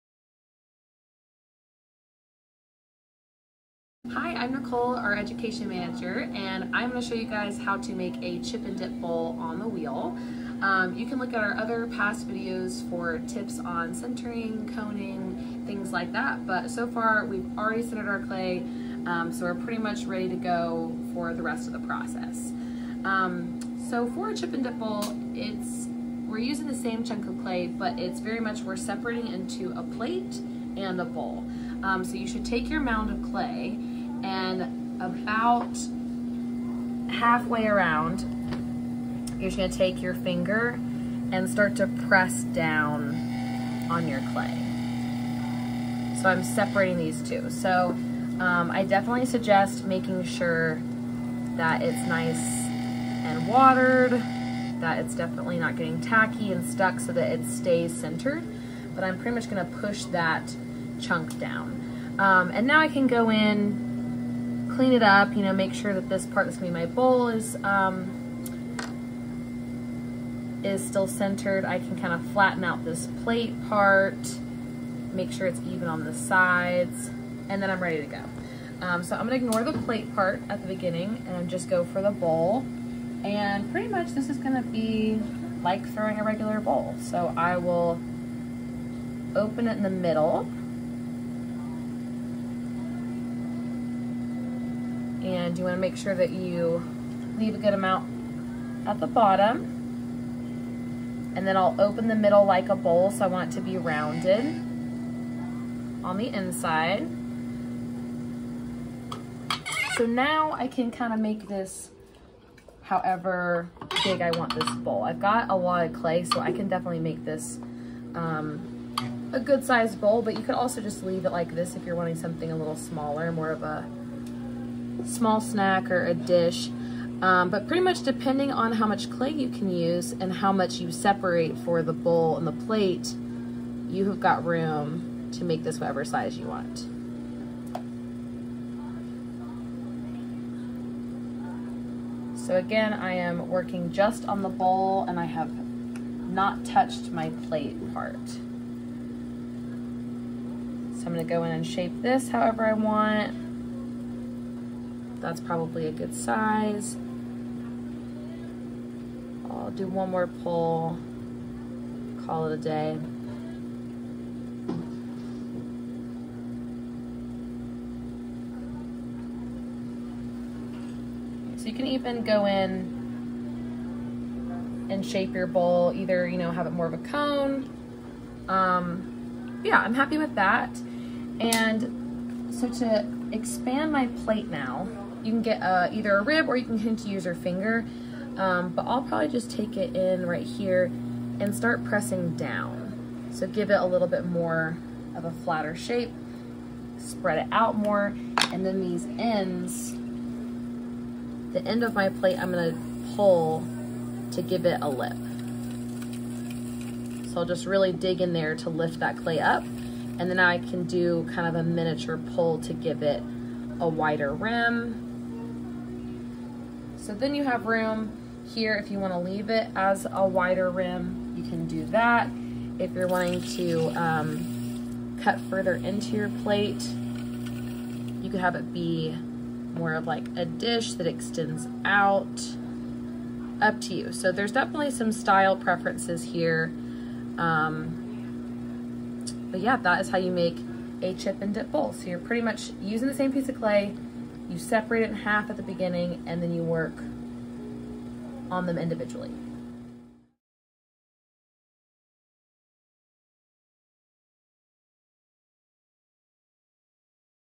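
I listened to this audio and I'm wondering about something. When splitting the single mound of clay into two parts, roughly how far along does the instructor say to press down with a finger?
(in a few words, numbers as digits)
Halfway.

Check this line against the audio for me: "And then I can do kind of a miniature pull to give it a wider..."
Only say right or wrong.
right.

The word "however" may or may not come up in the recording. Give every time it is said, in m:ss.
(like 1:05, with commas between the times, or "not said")
1:52, 2:32.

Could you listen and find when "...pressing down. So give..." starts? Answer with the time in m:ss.
3:11.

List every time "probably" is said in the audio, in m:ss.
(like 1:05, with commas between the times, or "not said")
2:35, 3:09.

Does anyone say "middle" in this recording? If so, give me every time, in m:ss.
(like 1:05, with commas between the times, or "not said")
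1:29, 1:42.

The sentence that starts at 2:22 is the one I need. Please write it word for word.
So again, I am working just on the bowl and I have not touched my plate part.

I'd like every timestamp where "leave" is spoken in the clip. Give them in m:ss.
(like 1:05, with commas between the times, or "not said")
1:37, 2:01, 3:39.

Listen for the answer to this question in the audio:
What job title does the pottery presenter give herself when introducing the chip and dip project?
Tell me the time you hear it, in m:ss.
0:05.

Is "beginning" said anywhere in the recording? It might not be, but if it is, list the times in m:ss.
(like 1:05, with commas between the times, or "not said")
1:20, 4:05.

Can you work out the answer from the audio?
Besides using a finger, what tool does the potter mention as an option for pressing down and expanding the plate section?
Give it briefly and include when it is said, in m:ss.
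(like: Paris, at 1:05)
A rib, at 3:06.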